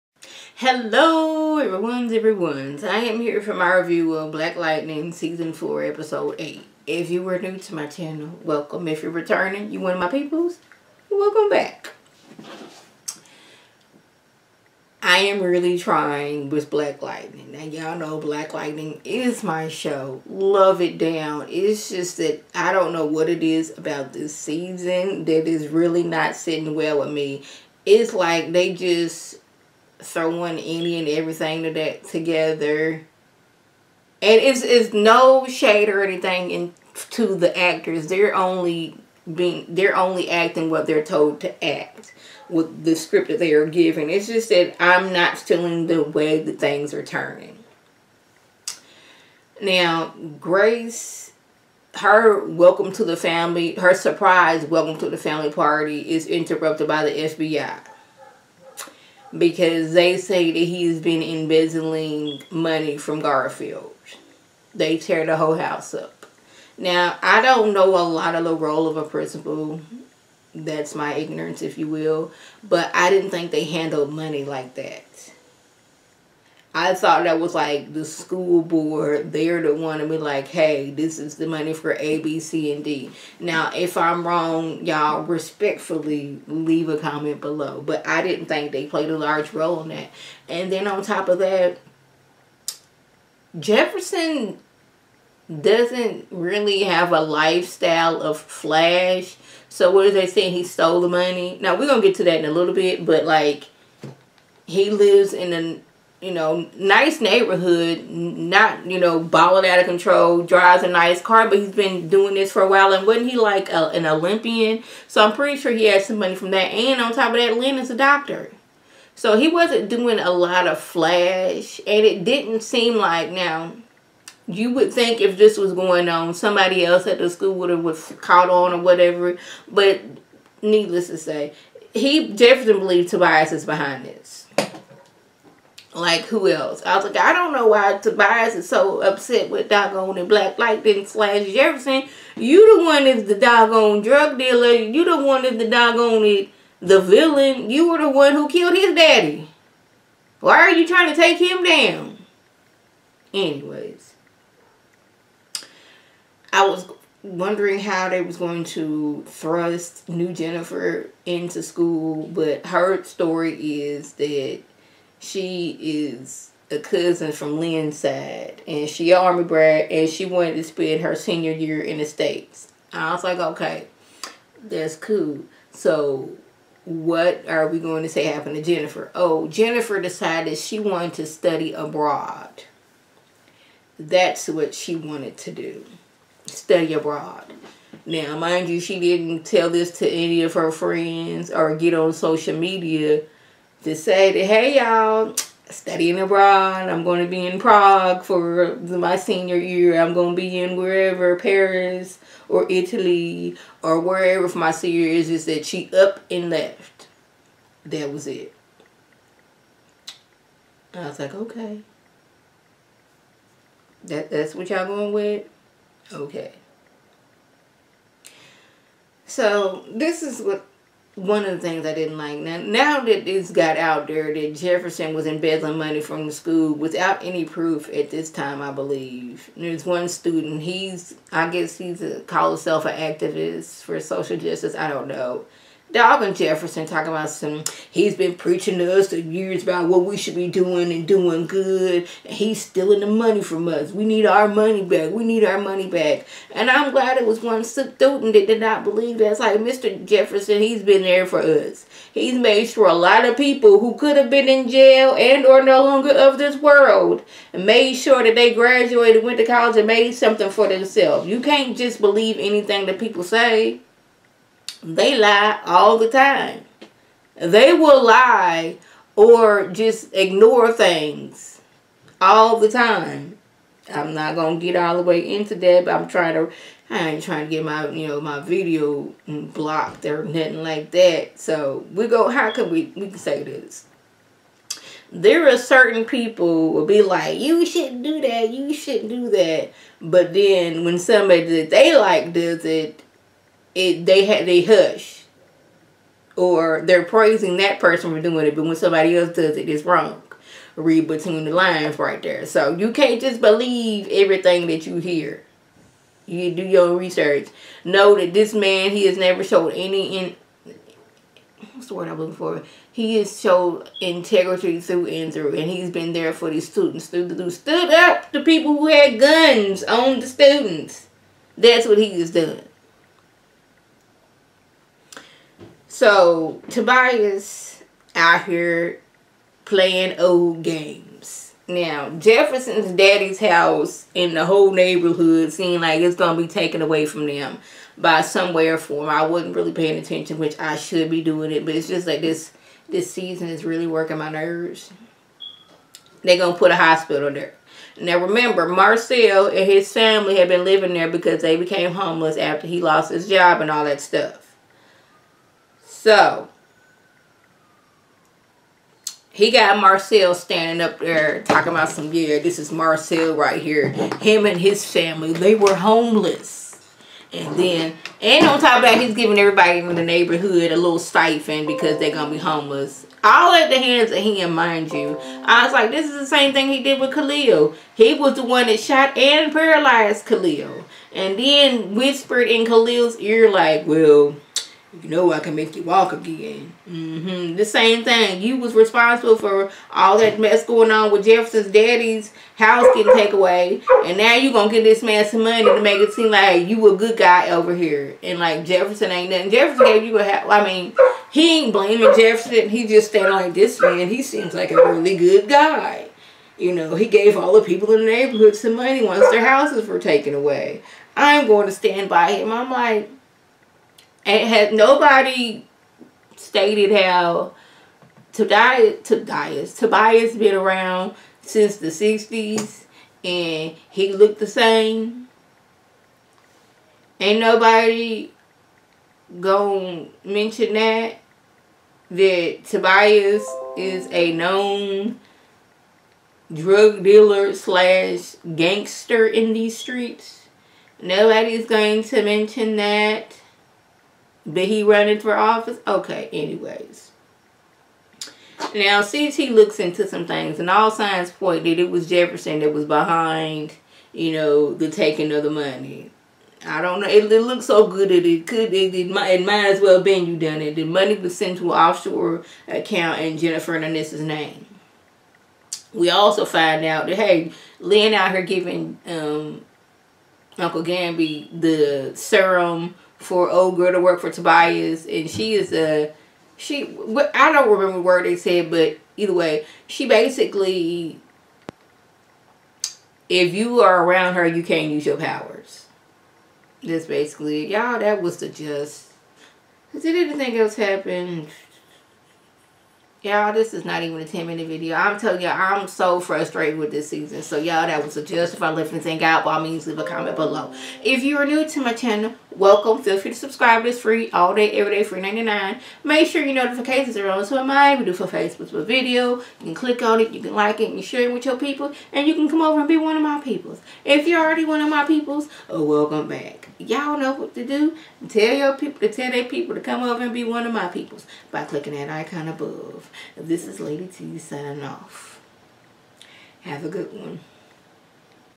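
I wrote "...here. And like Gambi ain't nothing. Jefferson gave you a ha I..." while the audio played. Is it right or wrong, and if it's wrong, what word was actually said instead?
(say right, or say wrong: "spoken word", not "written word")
wrong: "Jefferson", not "Gambi".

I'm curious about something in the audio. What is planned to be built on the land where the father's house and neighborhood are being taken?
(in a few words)
A hospital.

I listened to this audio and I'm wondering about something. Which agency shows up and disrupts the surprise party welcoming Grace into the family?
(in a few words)
FBI.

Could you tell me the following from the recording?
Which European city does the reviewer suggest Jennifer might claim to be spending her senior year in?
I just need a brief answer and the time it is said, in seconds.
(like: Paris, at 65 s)
Prague, at 197 s.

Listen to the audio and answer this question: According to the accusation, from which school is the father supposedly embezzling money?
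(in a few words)
Garfield.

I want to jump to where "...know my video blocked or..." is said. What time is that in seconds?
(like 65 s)
278 s.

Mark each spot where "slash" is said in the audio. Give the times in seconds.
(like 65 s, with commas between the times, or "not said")
141 s, 437 s.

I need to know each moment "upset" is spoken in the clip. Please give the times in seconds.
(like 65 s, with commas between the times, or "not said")
139 s.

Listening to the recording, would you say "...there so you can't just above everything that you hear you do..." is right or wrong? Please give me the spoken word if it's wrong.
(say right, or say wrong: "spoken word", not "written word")
wrong: "believe", not "above".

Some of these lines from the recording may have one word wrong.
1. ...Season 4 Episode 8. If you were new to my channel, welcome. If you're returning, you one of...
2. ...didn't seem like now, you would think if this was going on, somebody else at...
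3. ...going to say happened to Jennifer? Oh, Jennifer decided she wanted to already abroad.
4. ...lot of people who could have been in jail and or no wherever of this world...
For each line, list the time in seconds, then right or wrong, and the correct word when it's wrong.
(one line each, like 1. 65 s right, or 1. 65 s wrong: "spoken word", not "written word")
1. 5 s right
2. 122 s right
3. 177 s wrong: "study", not "already"
4. 252 s wrong: "longer", not "wherever".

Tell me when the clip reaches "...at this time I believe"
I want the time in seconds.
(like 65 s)
227 s.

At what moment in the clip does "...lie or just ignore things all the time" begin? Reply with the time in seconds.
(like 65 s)
268 s.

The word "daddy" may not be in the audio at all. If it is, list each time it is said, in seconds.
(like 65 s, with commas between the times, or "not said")
148 s, 332 s, 391 s.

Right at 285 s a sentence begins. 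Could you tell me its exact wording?
There are certain people will be like, you shouldn't do that, you shouldn't do that.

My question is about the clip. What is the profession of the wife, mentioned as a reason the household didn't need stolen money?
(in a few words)
Doctor.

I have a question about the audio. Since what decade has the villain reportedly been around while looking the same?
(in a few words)
The 60s.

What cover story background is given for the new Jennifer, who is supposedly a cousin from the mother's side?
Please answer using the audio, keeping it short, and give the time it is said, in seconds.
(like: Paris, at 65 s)
Army brat, at 169 s.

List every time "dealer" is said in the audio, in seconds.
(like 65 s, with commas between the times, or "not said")
144 s, 437 s.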